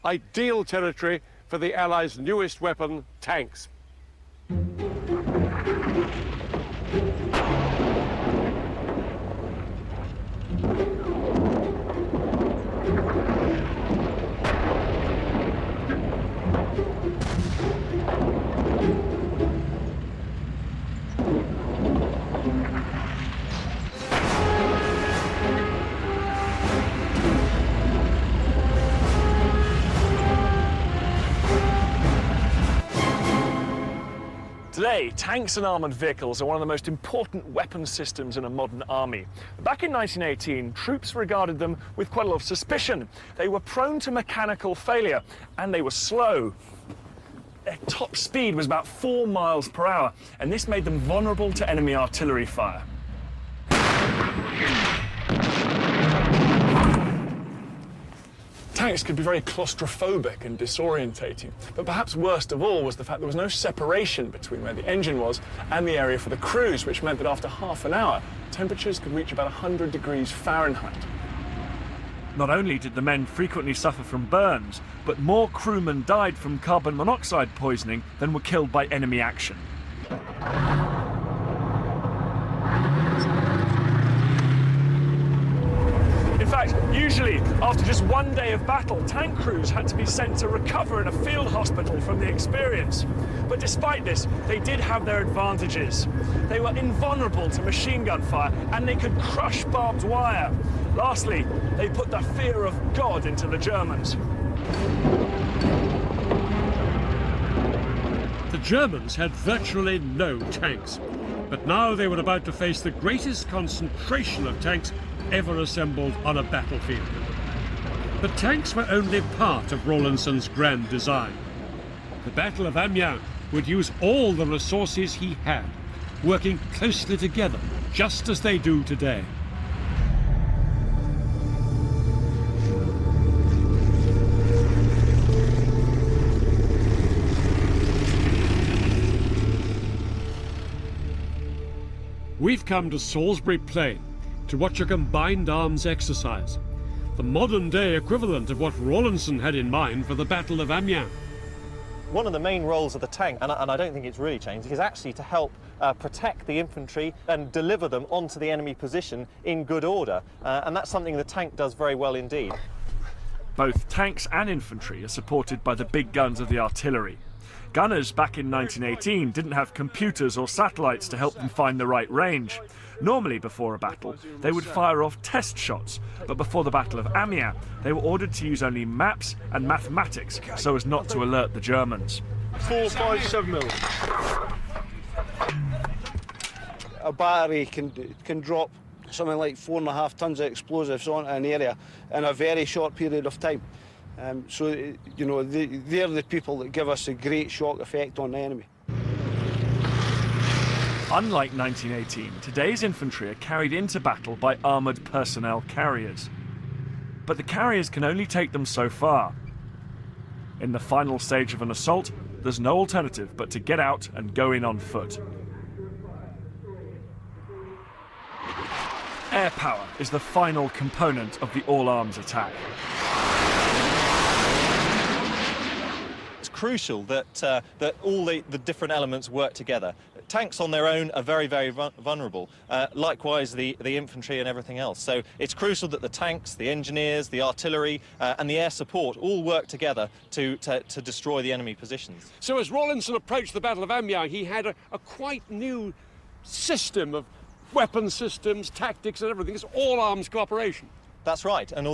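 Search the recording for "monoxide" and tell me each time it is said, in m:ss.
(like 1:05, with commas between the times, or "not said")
1:16.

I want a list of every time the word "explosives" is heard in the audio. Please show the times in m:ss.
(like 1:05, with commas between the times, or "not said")
3:10.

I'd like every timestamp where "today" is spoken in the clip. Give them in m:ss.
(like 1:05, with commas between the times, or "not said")
0:34, 2:08, 3:22.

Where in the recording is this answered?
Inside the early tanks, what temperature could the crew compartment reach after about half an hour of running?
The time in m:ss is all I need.
1:09.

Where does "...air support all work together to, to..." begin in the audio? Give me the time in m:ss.
3:58.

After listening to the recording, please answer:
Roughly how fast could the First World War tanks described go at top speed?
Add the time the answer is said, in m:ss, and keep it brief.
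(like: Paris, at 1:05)
4 miles per hour, at 0:48.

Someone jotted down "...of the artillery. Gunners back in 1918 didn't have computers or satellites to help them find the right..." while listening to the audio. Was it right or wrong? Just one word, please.
right.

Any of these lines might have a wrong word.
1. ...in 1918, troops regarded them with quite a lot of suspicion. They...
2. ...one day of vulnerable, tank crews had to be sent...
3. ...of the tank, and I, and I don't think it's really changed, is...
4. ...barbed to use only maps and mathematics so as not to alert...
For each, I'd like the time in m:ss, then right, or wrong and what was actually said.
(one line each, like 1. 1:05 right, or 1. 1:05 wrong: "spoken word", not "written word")
1. 0:39 right
2. 1:28 wrong: "battle", not "vulnerable"
3. 2:32 right
4. 2:58 wrong: "ordered", not "barbed".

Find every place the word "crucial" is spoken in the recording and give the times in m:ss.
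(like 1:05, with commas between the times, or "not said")
3:46, 3:55.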